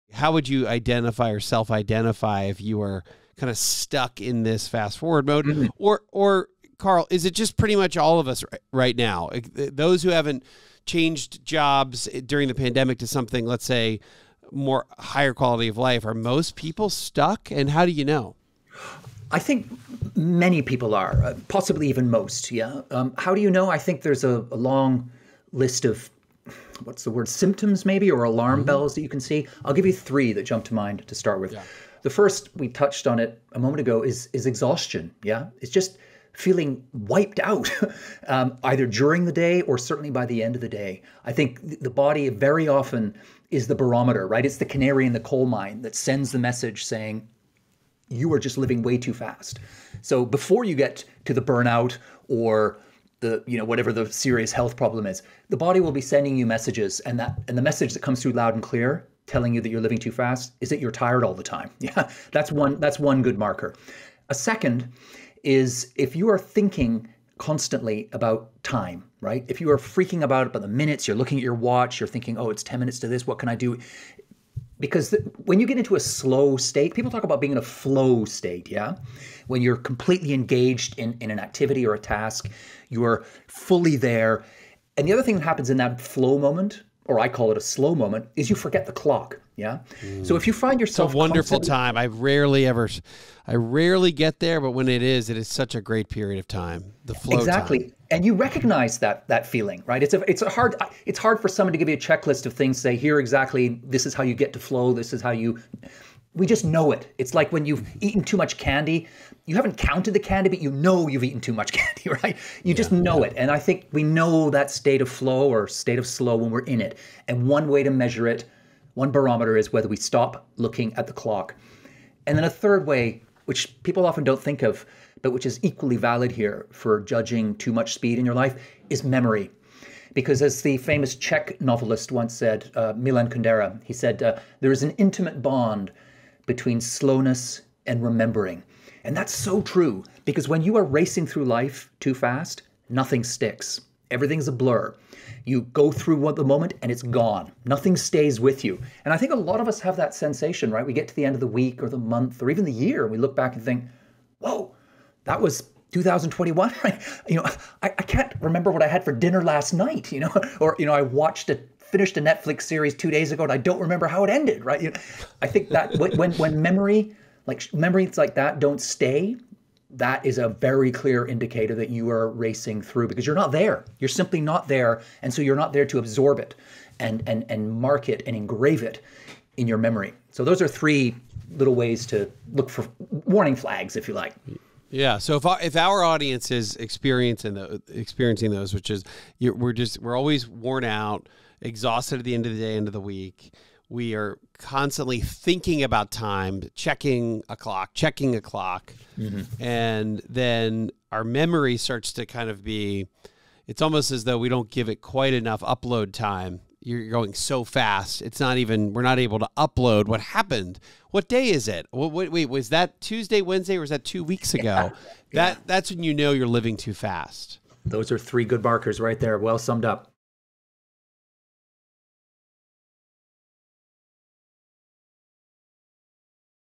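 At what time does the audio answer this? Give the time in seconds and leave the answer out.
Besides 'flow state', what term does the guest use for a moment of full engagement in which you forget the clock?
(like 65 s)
87 s.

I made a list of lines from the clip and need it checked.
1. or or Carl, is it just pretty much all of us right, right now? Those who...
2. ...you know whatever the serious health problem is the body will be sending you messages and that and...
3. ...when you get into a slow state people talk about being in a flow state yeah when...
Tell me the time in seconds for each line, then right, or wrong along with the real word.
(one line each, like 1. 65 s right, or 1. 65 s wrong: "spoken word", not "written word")
1. 5 s right
2. 53 s right
3. 75 s right.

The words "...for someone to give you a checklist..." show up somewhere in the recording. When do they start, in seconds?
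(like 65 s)
101 s.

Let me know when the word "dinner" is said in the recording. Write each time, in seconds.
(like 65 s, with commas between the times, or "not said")
159 s.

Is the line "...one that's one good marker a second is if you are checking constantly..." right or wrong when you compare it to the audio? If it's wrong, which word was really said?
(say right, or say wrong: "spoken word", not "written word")
wrong: "thinking", not "checking".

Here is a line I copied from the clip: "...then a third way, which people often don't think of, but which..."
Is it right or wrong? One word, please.
right.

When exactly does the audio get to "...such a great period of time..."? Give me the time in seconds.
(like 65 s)
95 s.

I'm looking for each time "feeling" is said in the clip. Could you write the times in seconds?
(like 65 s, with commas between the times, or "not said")
36 s, 99 s.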